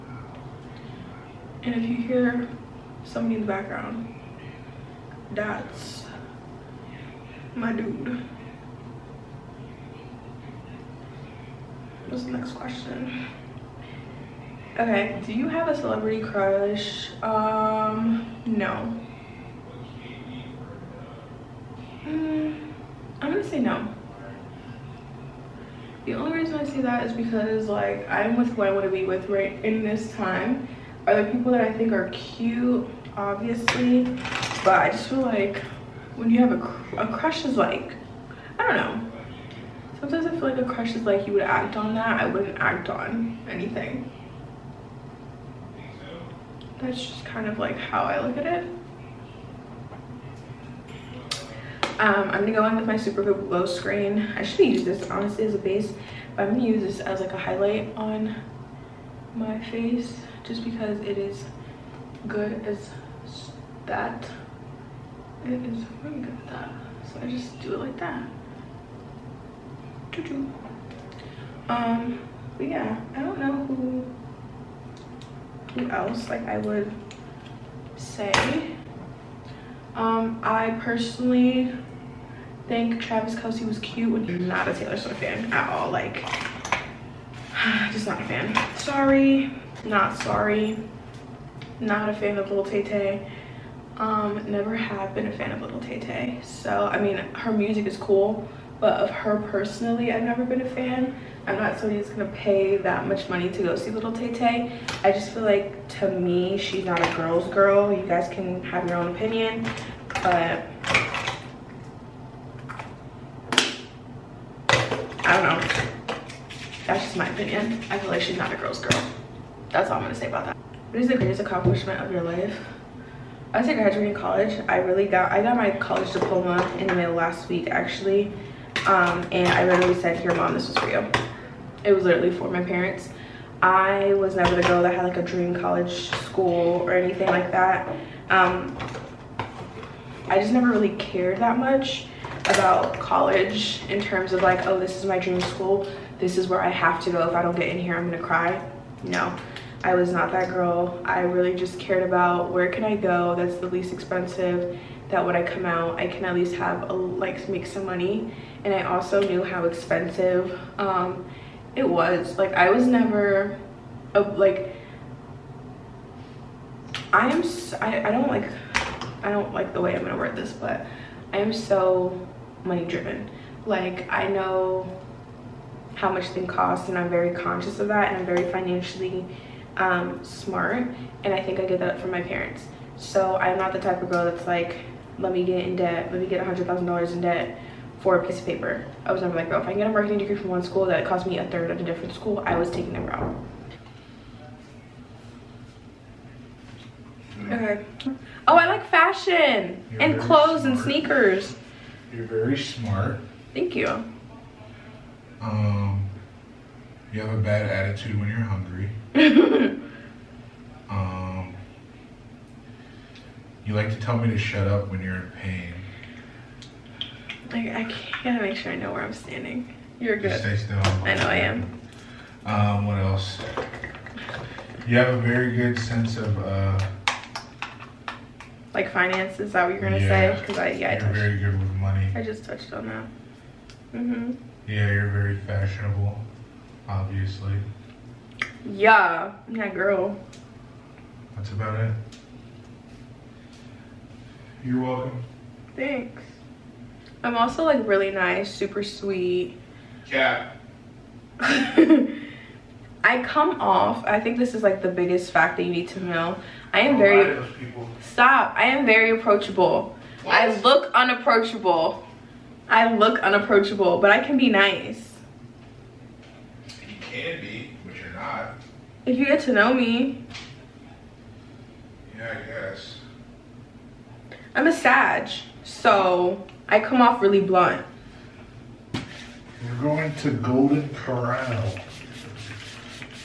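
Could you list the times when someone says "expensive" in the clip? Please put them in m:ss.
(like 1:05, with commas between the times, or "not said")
2:33, 2:39.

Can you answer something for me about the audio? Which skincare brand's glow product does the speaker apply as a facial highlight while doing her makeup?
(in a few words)
Supergoop.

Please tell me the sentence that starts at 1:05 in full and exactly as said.
It is really good at that.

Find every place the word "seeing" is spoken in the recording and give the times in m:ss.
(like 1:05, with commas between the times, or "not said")
not said.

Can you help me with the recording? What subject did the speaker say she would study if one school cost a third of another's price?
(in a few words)
Marketing.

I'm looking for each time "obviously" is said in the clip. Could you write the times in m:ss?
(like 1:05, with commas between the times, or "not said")
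0:33, 3:56.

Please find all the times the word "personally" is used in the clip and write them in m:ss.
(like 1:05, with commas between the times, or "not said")
1:20, 1:39.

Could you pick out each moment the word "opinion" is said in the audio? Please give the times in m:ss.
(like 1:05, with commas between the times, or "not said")
1:49, 1:57.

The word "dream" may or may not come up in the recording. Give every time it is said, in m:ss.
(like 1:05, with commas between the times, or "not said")
2:15, 2:25.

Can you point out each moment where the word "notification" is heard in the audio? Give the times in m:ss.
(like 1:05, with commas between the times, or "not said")
not said.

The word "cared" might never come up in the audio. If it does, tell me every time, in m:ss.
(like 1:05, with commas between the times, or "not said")
2:20, 2:31.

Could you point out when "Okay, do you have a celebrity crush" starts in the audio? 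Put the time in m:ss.
0:14.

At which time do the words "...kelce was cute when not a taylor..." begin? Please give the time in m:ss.
1:23.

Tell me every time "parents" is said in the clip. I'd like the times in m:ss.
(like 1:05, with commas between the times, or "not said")
2:12, 3:02.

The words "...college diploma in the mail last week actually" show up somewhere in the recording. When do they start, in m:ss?
2:05.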